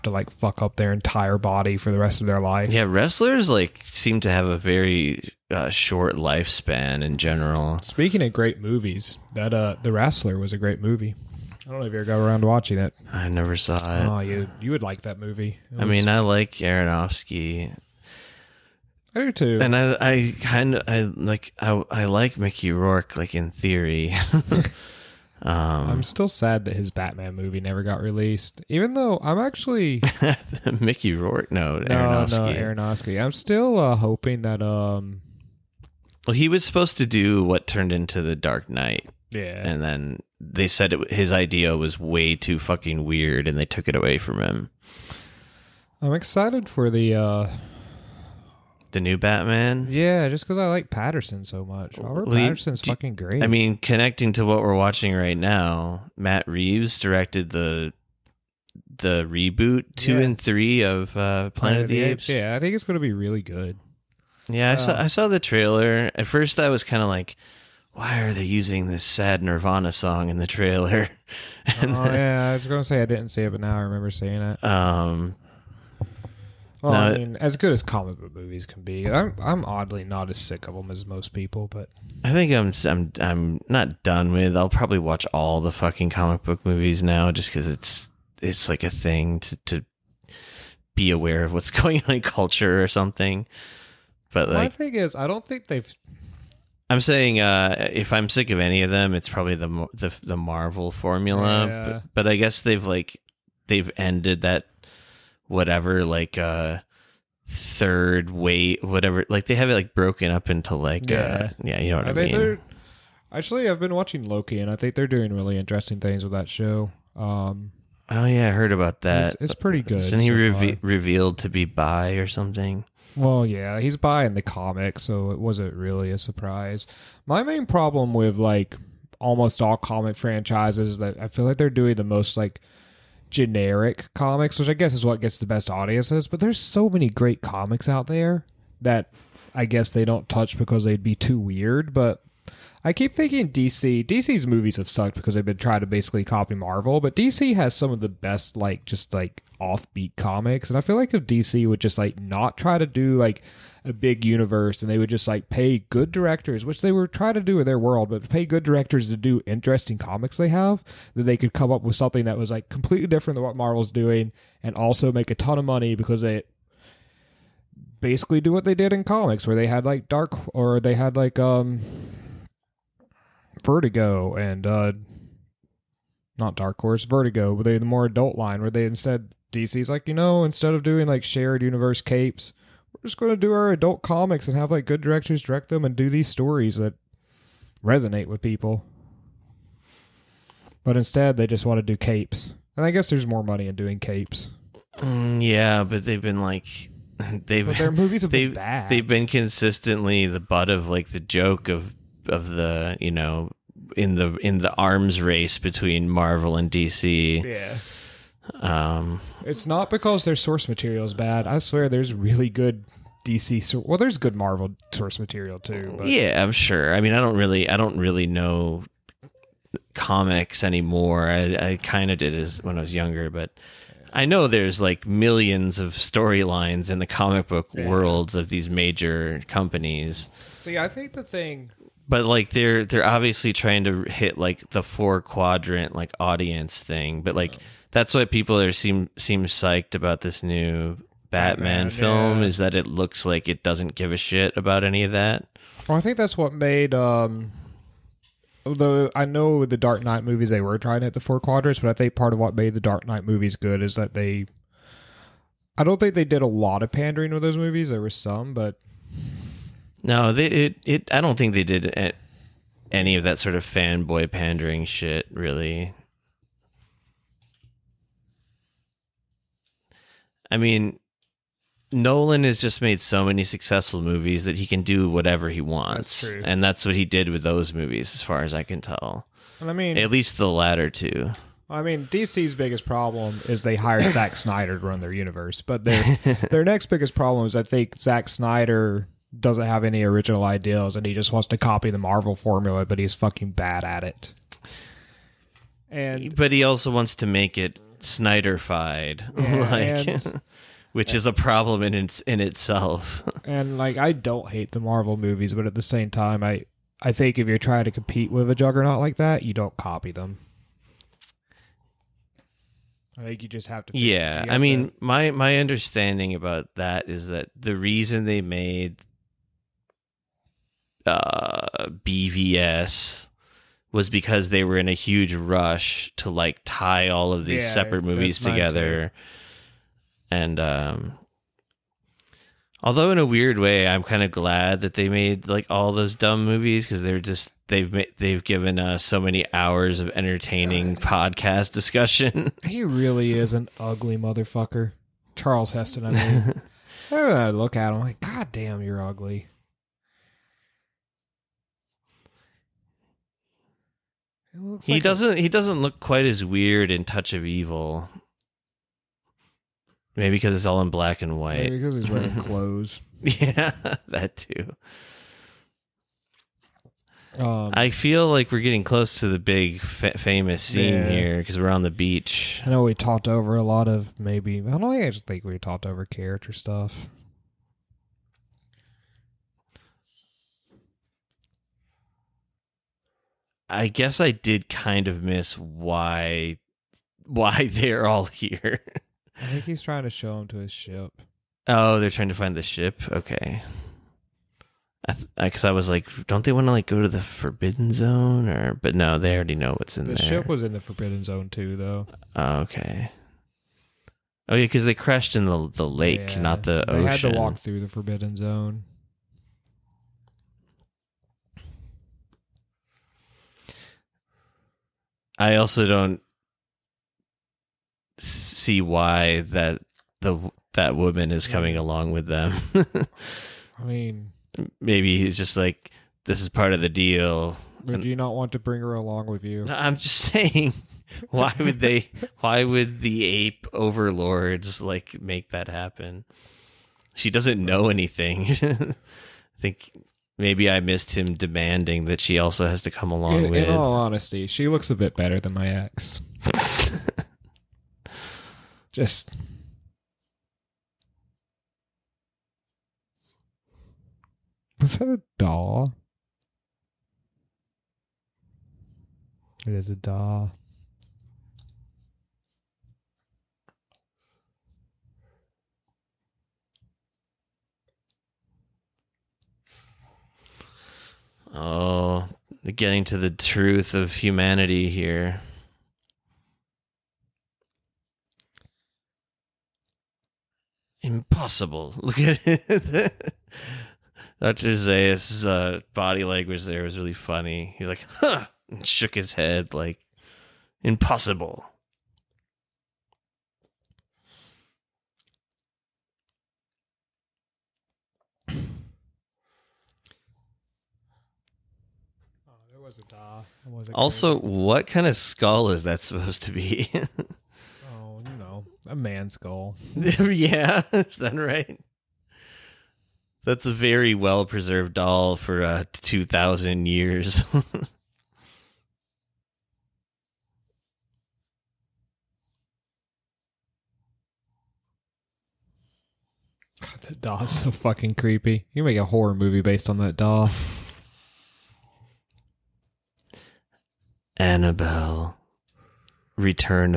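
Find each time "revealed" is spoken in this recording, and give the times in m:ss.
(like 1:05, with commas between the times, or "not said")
2:00.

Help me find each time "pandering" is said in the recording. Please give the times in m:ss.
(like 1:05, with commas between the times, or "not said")
4:16, 4:24.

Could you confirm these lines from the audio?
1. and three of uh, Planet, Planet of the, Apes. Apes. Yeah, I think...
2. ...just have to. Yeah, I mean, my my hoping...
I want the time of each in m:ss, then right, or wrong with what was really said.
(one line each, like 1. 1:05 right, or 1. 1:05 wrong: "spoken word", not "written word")
1. 1:00 right
2. 5:13 wrong: "understanding", not "hoping".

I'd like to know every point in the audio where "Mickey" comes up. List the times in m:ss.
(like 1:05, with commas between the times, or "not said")
0:22, 0:30.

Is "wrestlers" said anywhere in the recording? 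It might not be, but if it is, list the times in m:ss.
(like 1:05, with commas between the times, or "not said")
0:02, 0:09.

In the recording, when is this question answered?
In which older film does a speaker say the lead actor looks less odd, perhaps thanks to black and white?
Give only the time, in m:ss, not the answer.
5:57.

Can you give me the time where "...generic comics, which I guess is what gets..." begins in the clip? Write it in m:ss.
2:13.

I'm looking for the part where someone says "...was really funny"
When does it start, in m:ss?
8:06.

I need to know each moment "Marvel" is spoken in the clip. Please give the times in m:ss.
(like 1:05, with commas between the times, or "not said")
1:40, 2:26, 2:43, 3:26, 3:34, 4:51, 5:04.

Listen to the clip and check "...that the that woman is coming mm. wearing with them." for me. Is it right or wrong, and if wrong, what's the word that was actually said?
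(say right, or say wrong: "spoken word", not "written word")
wrong: "along", not "wearing".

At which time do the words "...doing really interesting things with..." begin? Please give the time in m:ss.
1:55.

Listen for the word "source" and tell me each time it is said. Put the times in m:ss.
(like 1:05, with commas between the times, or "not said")
3:30, 3:34.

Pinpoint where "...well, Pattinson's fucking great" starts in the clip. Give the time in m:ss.
0:52.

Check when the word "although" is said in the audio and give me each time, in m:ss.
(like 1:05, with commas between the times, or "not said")
4:08, 5:32.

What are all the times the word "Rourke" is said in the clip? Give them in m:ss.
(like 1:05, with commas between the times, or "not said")
0:22, 0:31.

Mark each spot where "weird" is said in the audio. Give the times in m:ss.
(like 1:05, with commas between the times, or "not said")
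0:43, 2:21, 5:33, 5:56.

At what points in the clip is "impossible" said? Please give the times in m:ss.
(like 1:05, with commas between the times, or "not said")
8:01, 8:10.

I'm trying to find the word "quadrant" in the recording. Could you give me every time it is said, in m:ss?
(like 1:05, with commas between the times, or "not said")
3:55, 4:11.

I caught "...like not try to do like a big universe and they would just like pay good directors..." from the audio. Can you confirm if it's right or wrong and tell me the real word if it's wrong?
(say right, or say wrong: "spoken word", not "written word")
right.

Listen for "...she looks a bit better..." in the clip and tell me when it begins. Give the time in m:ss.
7:24.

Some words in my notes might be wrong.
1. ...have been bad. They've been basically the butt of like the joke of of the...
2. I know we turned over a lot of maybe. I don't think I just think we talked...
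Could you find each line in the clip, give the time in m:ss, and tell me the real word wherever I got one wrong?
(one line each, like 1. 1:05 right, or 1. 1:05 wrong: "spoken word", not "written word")
1. 3:18 wrong: "consistently", not "basically"
2. 6:12 wrong: "talked", not "turned".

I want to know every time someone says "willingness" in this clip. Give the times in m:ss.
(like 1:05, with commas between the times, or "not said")
not said.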